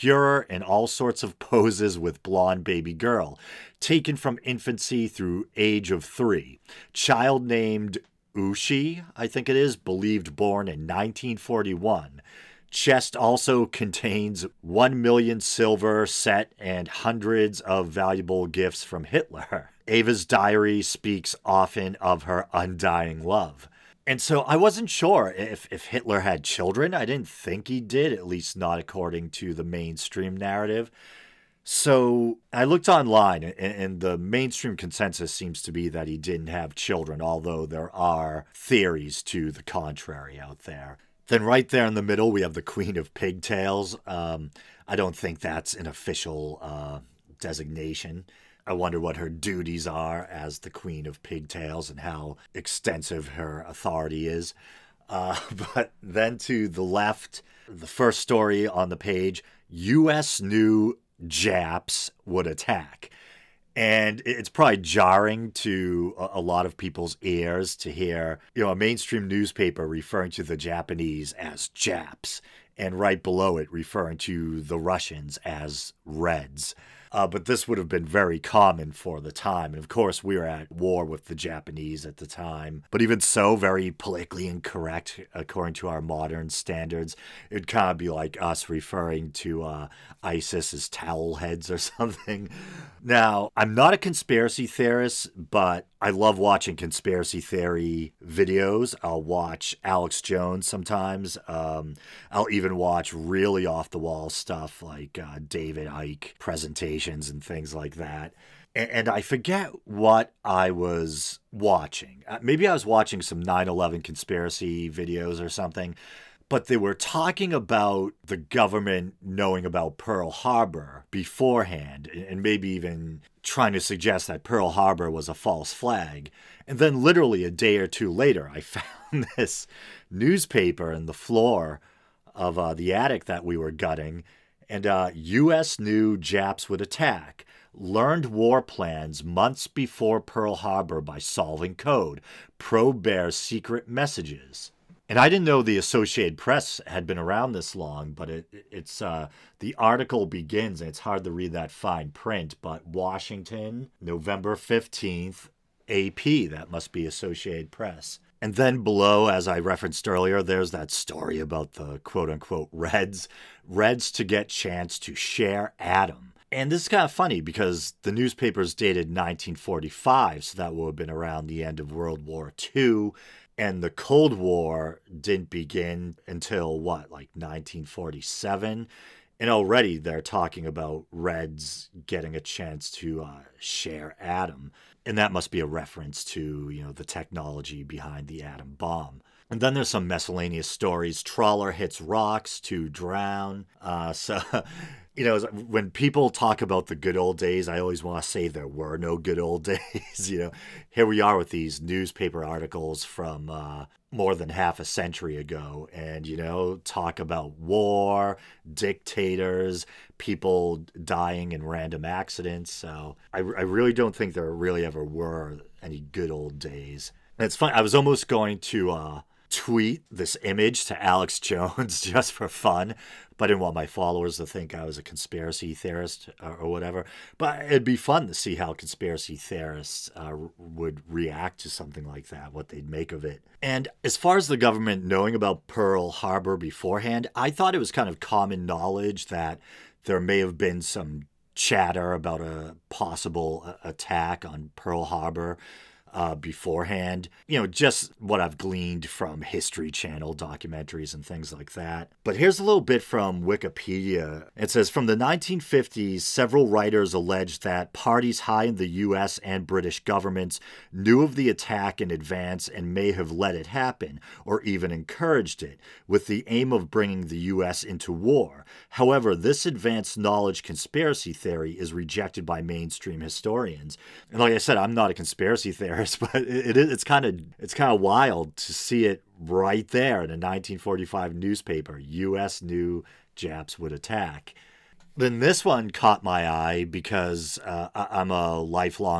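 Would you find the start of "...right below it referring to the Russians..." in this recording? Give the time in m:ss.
1:12.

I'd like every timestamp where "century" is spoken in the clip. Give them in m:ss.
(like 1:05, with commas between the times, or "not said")
3:24.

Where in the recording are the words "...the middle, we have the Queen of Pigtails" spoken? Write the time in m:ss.
0:41.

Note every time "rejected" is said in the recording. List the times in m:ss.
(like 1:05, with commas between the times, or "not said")
4:31.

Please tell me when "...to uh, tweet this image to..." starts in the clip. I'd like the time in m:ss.
3:38.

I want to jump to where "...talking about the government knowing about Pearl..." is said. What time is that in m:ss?
1:56.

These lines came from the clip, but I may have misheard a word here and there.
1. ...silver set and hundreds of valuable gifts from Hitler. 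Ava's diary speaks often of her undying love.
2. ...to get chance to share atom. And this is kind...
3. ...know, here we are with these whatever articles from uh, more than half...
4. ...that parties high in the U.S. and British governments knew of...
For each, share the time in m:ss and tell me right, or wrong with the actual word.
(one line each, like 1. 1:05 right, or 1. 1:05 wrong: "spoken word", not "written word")
1. 0:15 right
2. 2:44 right
3. 3:20 wrong: "newspaper", not "whatever"
4. 4:17 right.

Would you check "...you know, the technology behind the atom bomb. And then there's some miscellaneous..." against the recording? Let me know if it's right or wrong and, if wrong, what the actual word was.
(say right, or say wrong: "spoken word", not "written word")
right.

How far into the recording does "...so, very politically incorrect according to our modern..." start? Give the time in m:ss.
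1:23.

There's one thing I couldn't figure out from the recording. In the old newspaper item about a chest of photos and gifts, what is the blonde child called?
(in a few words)
Ushi.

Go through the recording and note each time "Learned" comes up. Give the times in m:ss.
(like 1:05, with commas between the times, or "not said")
2:17.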